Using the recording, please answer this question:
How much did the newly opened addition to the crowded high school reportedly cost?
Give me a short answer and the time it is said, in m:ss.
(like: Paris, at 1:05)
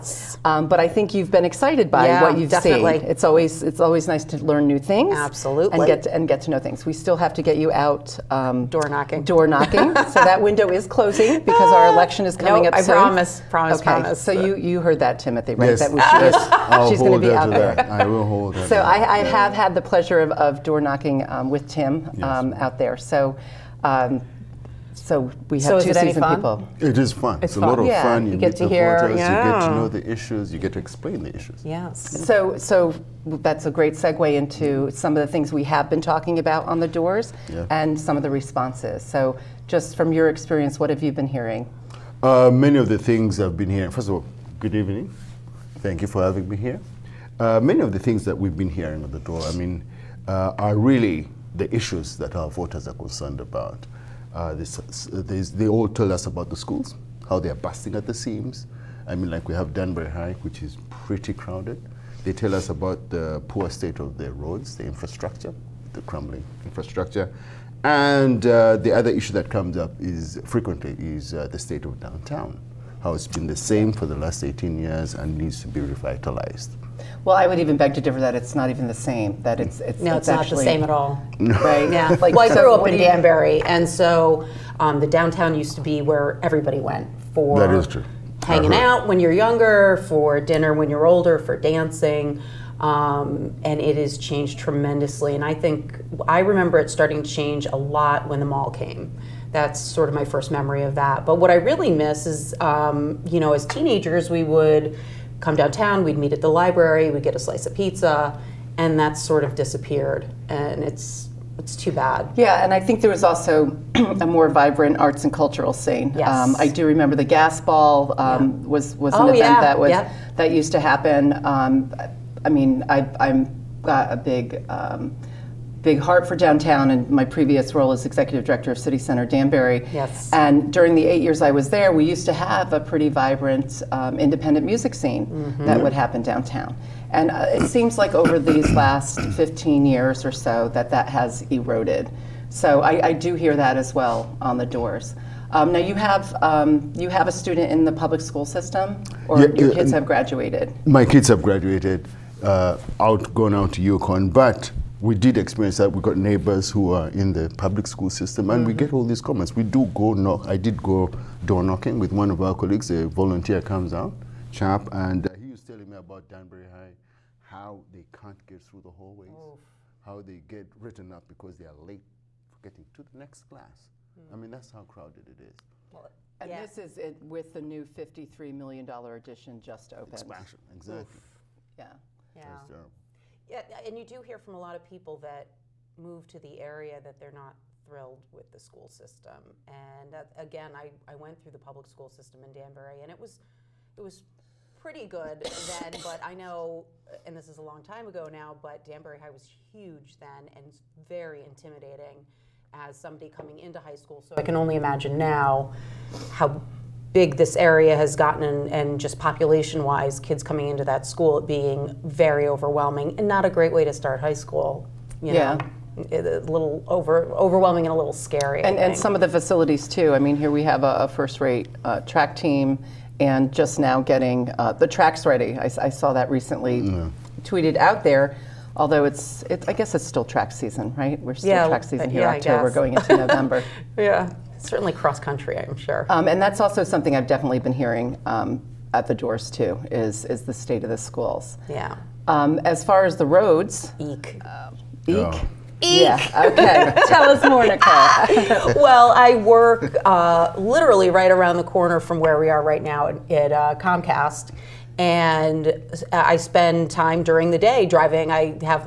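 $53 million, at 2:57.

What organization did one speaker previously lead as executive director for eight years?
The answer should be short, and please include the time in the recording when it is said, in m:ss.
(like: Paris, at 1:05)
City Center Danbury, at 2:08.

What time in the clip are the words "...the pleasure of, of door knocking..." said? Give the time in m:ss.
0:19.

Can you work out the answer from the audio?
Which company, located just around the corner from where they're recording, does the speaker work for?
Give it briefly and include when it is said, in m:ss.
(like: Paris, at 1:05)
Comcast, at 4:13.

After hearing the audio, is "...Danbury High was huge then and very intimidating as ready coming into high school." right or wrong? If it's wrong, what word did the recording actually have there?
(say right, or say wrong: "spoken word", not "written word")
wrong: "somebody", not "ready".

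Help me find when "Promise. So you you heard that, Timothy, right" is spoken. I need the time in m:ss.
0:13.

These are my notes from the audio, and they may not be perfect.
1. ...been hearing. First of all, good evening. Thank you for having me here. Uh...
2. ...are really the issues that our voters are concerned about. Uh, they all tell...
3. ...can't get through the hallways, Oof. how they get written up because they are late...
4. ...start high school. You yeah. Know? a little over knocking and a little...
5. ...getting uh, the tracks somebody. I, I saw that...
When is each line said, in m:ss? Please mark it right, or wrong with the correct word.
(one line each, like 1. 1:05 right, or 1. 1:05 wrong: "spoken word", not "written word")
1. 0:43 right
2. 0:50 right
3. 2:48 right
4. 3:33 wrong: "overwhelming", not "knocking"
5. 3:43 wrong: "ready", not "somebody".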